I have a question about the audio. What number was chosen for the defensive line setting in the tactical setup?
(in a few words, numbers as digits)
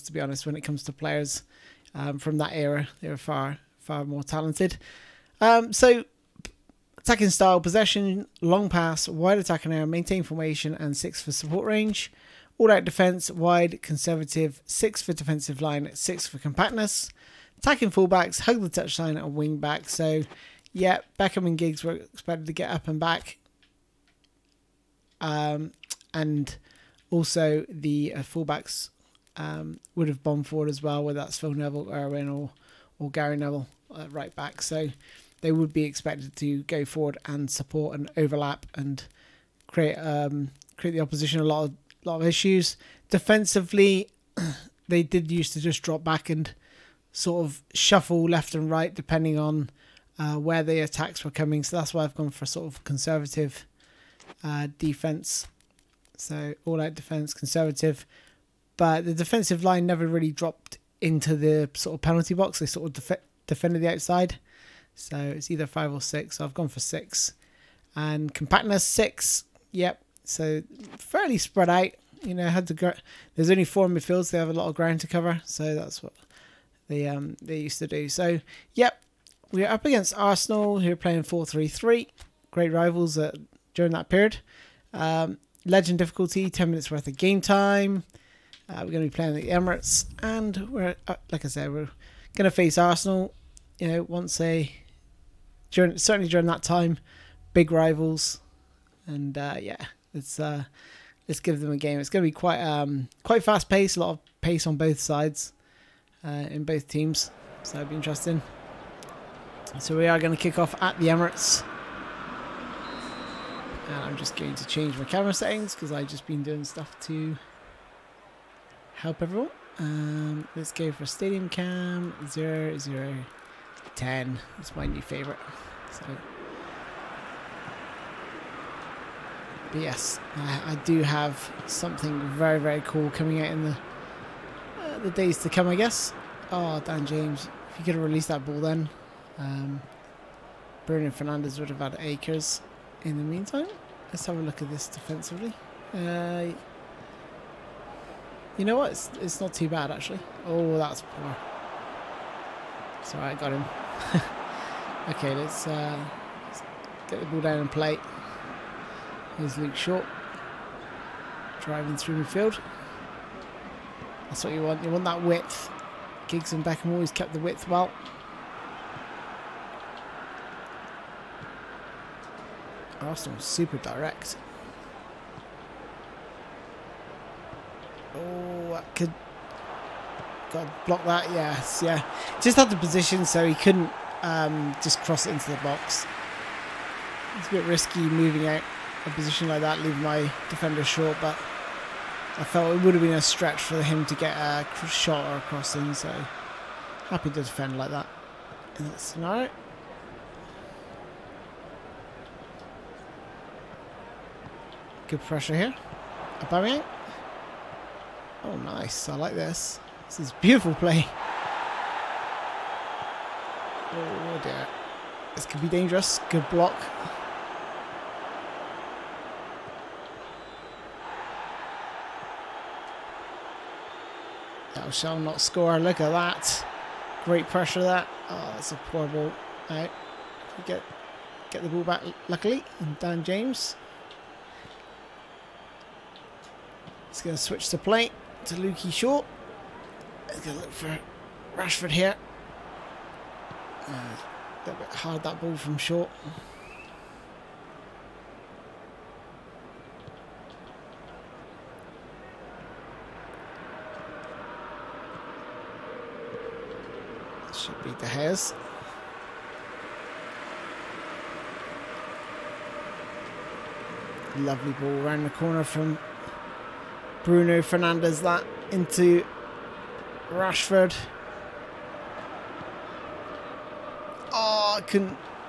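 6.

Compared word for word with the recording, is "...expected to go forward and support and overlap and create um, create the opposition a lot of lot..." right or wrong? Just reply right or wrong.
right.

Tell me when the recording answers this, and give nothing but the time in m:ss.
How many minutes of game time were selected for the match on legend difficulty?
1:26.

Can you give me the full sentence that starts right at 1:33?
You know, once a during certainly during that time, big rivals, and uh, yeah, let's uh, let's give them a game.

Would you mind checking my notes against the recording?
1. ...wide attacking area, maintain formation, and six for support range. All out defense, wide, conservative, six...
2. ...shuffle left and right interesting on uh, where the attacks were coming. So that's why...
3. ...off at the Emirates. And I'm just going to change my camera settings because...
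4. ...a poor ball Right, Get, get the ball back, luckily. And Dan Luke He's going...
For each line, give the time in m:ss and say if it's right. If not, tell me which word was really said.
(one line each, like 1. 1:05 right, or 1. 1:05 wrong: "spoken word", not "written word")
1. 0:09 right
2. 0:47 wrong: "depending", not "interesting"
3. 1:50 right
4. 3:48 wrong: "James", not "Luke".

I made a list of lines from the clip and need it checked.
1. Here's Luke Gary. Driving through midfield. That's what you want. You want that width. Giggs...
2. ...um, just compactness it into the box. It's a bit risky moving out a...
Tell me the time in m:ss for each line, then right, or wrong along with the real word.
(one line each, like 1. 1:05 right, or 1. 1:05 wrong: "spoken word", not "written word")
1. 2:39 wrong: "Shaw", not "Gary"
2. 3:04 wrong: "cross", not "compactness".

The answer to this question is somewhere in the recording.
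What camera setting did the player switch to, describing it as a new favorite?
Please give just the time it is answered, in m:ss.
2:01.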